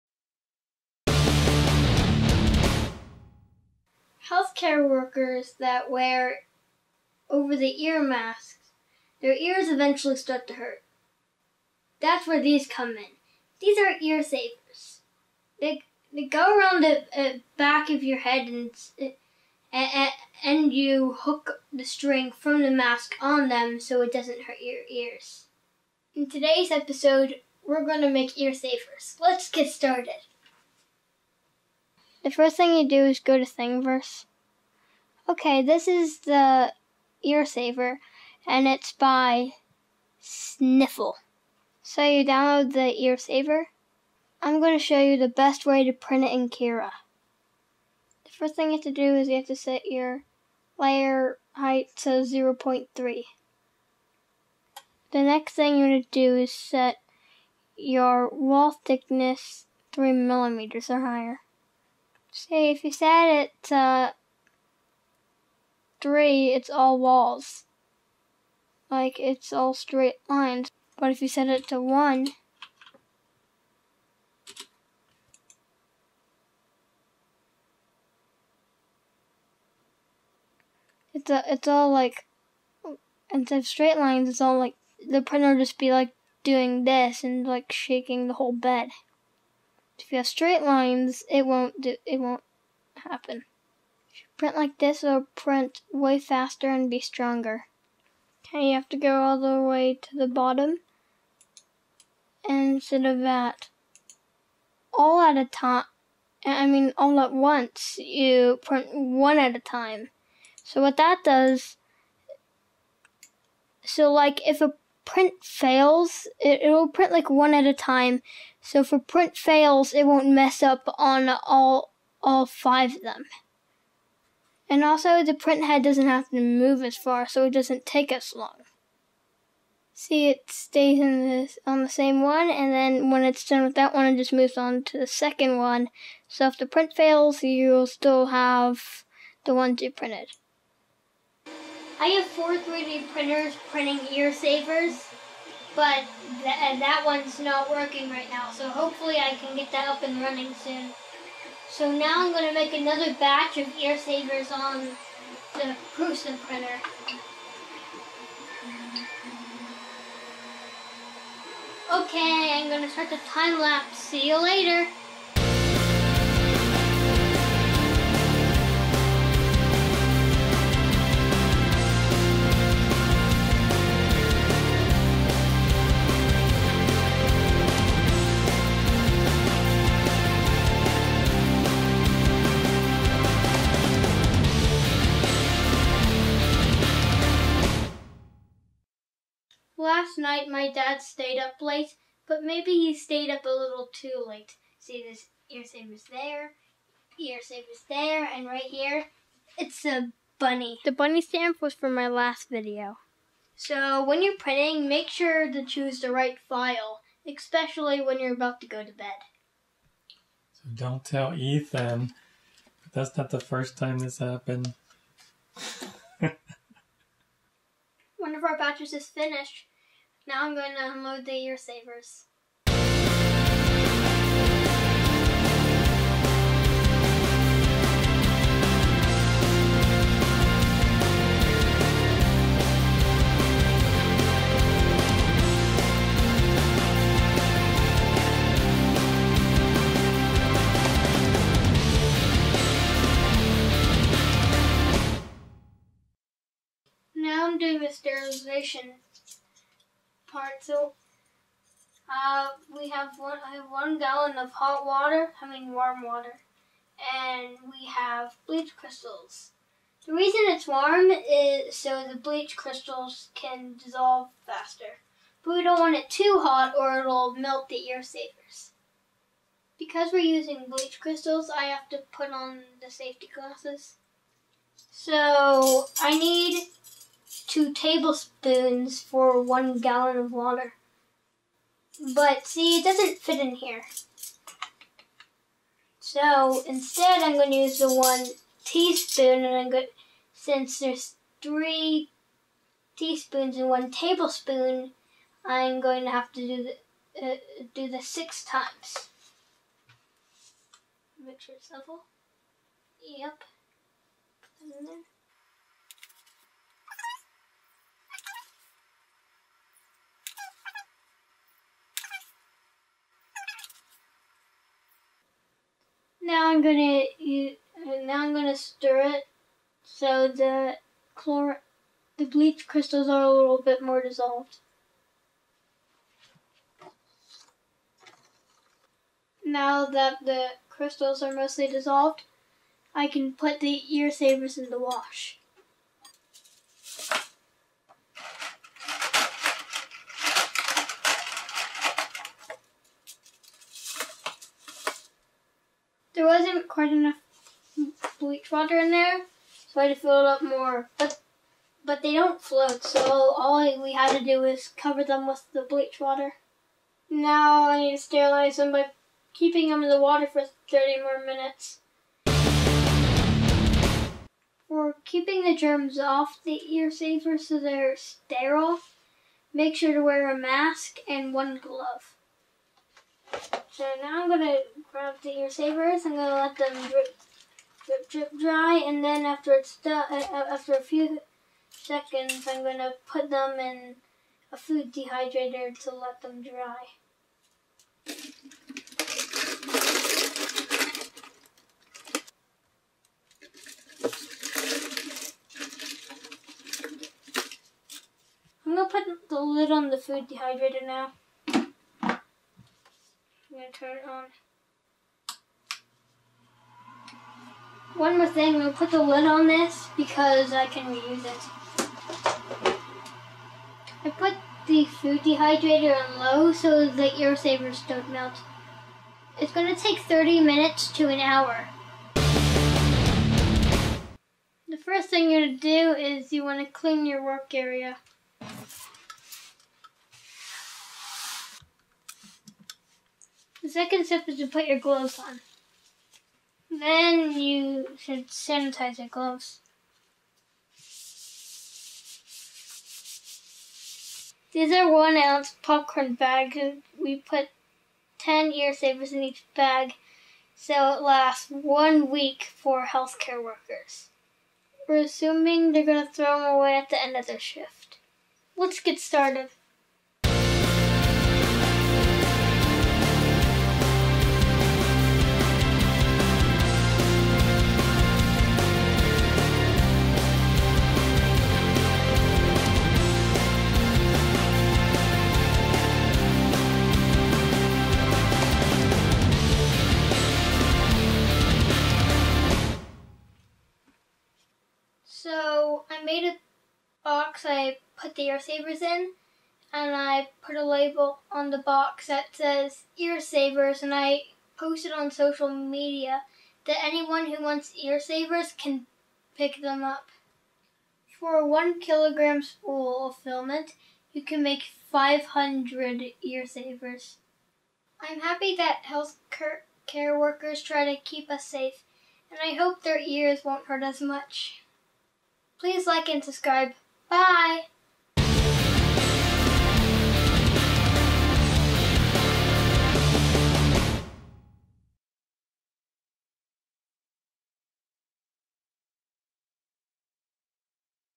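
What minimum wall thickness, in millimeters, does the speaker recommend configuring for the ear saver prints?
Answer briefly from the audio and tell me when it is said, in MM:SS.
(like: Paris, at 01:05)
3 millimeters, at 00:59.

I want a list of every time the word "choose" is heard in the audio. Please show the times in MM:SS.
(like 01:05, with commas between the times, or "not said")
03:25.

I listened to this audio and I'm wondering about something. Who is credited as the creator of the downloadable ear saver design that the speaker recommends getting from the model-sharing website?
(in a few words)
Sniffle.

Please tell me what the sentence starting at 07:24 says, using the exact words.
These are one ounce popcorn bags.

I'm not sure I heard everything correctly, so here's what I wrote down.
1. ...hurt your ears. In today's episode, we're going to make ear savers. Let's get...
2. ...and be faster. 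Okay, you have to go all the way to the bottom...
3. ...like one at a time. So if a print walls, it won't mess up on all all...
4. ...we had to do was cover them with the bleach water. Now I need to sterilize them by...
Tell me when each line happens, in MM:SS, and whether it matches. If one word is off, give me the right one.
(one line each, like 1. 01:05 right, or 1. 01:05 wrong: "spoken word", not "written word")
1. 00:24 right
2. 01:36 wrong: "stronger", not "faster"
3. 01:57 wrong: "fails", not "walls"
4. 05:53 right.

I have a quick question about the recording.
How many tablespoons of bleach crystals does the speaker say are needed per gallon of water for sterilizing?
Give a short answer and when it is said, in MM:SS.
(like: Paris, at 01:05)
2, at 04:37.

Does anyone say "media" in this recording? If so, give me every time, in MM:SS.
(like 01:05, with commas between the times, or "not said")
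08:15.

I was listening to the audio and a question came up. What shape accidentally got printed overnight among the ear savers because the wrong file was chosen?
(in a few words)
a bunny.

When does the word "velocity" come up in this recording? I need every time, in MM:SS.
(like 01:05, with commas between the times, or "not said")
not said.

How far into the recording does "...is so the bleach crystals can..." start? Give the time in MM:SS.
04:21.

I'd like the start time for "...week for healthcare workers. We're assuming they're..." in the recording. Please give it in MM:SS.
07:32.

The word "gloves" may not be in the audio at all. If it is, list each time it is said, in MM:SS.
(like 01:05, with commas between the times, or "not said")
06:11, 07:14, 07:19.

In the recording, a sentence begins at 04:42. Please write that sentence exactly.
But see, it doesn't fit in here.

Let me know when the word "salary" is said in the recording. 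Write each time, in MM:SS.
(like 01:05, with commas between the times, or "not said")
not said.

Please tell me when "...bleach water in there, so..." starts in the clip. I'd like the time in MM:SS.
05:48.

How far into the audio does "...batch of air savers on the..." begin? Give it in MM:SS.
02:33.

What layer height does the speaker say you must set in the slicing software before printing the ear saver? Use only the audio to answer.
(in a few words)
0.3.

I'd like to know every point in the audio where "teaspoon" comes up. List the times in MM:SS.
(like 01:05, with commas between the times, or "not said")
04:48, 04:52.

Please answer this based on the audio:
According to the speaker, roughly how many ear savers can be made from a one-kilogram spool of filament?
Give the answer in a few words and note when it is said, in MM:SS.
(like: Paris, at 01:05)
500, at 08:24.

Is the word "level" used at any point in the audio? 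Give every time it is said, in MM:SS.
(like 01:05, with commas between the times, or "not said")
05:01.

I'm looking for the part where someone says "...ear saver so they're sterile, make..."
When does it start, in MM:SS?
06:06.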